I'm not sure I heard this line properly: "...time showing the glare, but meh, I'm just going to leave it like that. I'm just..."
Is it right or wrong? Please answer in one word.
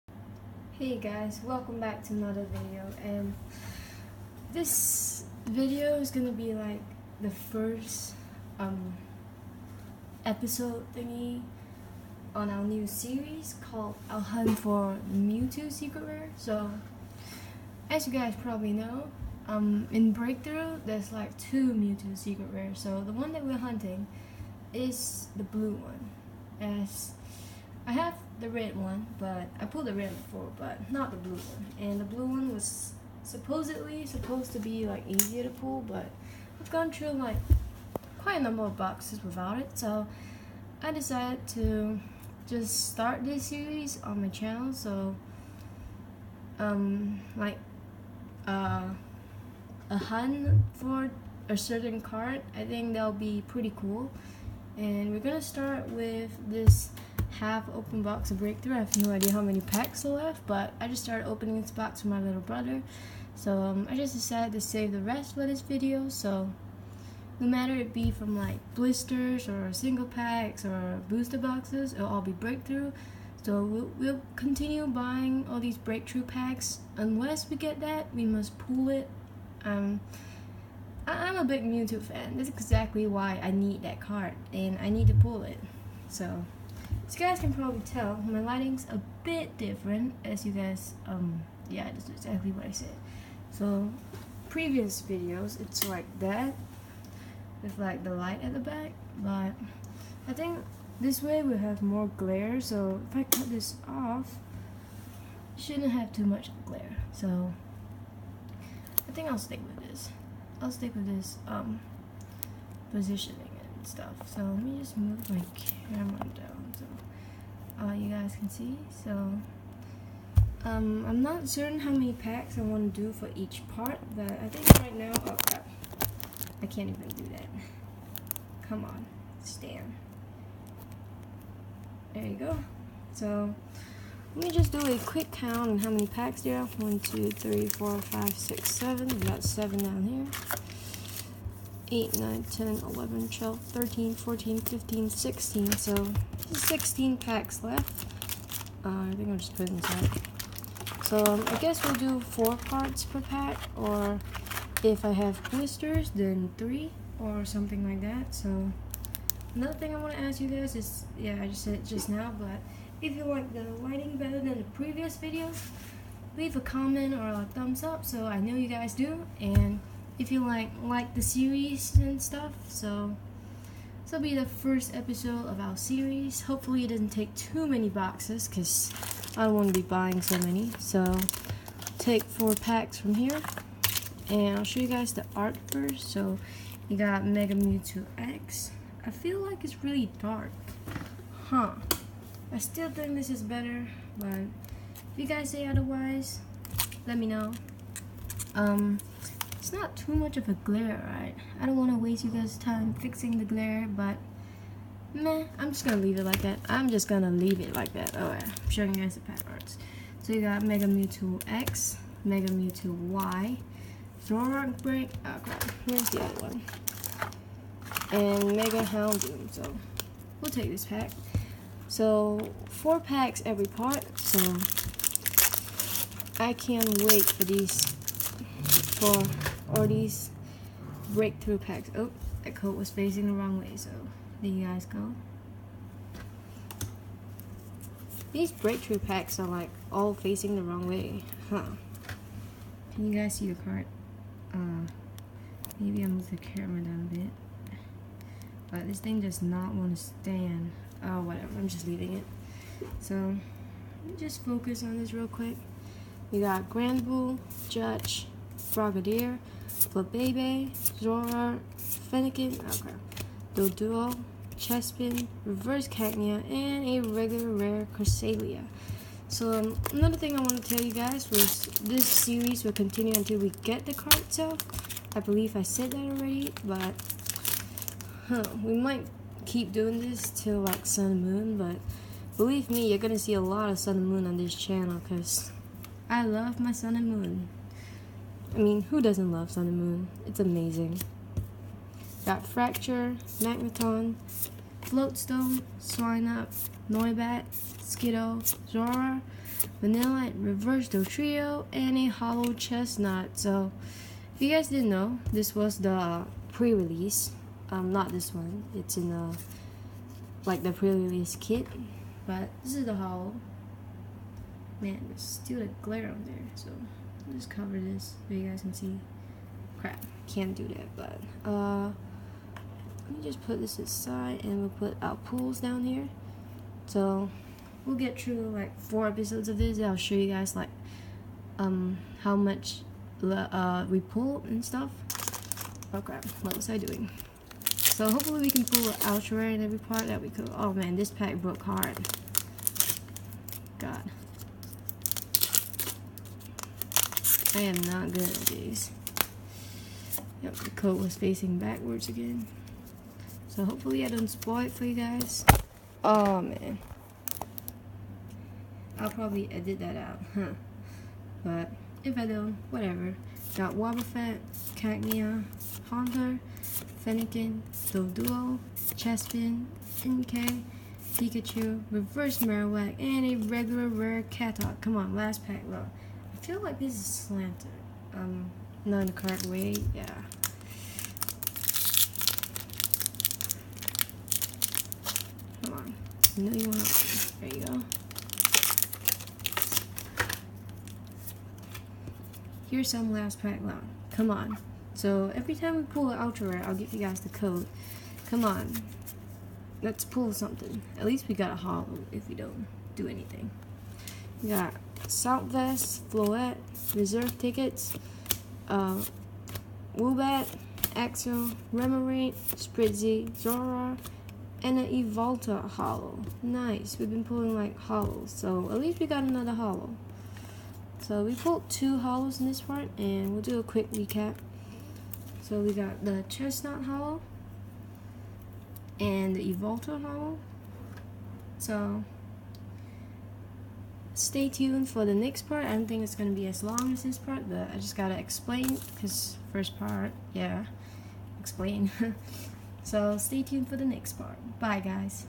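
wrong.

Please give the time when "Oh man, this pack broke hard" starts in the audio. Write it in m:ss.
5:40.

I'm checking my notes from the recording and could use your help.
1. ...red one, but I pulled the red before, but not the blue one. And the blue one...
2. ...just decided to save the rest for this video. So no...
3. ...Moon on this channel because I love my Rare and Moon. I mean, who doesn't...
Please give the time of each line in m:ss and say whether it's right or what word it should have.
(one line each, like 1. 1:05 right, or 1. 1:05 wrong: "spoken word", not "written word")
1. 0:28 right
2. 1:03 right
3. 4:44 wrong: "Sun", not "Rare".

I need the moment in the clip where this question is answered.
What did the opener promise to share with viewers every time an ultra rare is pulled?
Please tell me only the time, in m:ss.
6:37.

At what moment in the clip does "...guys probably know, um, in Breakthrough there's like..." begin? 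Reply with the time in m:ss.
0:18.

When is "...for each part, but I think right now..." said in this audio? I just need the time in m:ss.
2:03.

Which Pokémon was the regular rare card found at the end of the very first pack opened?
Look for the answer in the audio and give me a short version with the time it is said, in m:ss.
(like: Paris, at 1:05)
Cresselia, at 4:27.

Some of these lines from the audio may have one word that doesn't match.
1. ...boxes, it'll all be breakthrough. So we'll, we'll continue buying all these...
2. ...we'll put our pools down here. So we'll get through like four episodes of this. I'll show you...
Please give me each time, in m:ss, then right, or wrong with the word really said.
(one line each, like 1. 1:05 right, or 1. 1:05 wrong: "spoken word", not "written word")
1. 1:11 right
2. 5:24 right.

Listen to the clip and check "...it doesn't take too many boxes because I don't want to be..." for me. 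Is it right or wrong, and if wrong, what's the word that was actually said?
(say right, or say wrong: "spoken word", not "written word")
right.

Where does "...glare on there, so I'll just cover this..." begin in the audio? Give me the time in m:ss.
5:15.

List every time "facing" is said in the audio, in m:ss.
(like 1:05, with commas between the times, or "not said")
3:52, 4:00, 5:51.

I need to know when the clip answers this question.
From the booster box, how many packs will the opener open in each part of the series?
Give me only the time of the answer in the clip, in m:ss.
2:32.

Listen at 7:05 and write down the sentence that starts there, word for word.
So we got the Chesnaught Hollow and the Evolta Hollow.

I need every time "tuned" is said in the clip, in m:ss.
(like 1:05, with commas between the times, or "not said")
7:14, 7:23.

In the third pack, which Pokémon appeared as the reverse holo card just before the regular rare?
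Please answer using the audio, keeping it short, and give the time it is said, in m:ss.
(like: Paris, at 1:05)
Marowak, at 6:12.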